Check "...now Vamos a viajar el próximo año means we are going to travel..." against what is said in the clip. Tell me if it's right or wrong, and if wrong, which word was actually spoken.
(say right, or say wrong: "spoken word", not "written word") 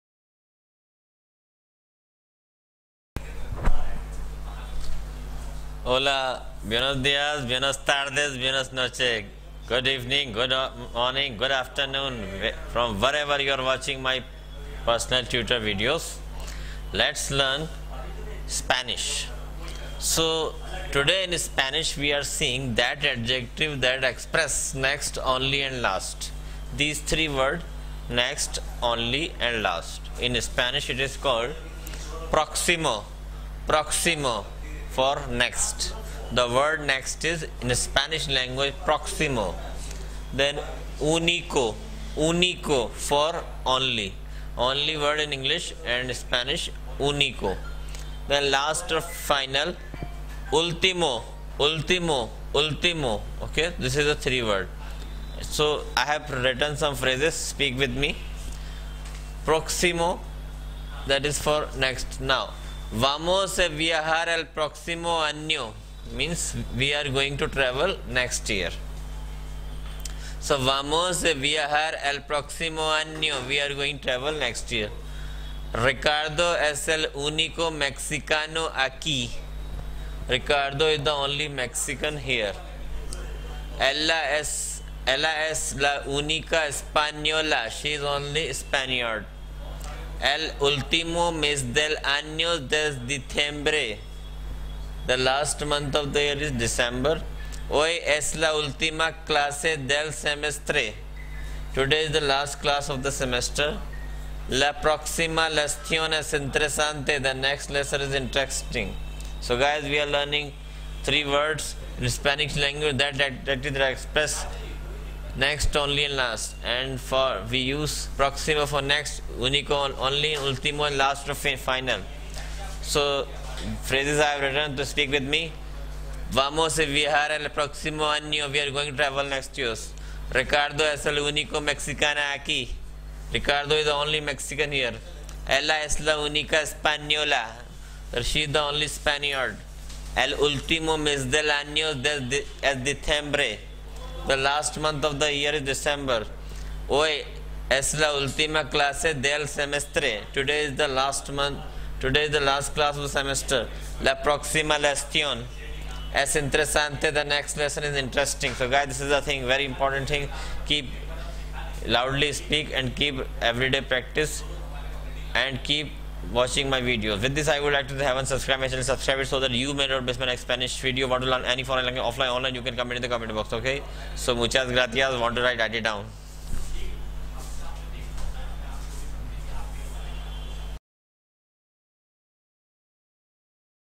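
right.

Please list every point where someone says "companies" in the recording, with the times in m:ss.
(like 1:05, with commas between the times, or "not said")
not said.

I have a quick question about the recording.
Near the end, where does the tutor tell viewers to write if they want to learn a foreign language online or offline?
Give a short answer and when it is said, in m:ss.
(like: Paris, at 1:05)
comment box, at 2:53.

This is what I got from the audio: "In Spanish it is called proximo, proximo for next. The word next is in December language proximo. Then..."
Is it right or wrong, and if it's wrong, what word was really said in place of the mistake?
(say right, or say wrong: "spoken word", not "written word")
wrong: "Spanish", not "December".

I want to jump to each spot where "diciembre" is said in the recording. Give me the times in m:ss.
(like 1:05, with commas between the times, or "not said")
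1:33, 2:22.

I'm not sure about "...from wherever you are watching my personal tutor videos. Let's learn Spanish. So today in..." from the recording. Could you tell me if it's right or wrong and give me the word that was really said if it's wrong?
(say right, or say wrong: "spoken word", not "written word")
right.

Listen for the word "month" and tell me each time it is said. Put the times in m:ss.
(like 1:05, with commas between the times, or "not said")
1:35, 2:24, 2:31.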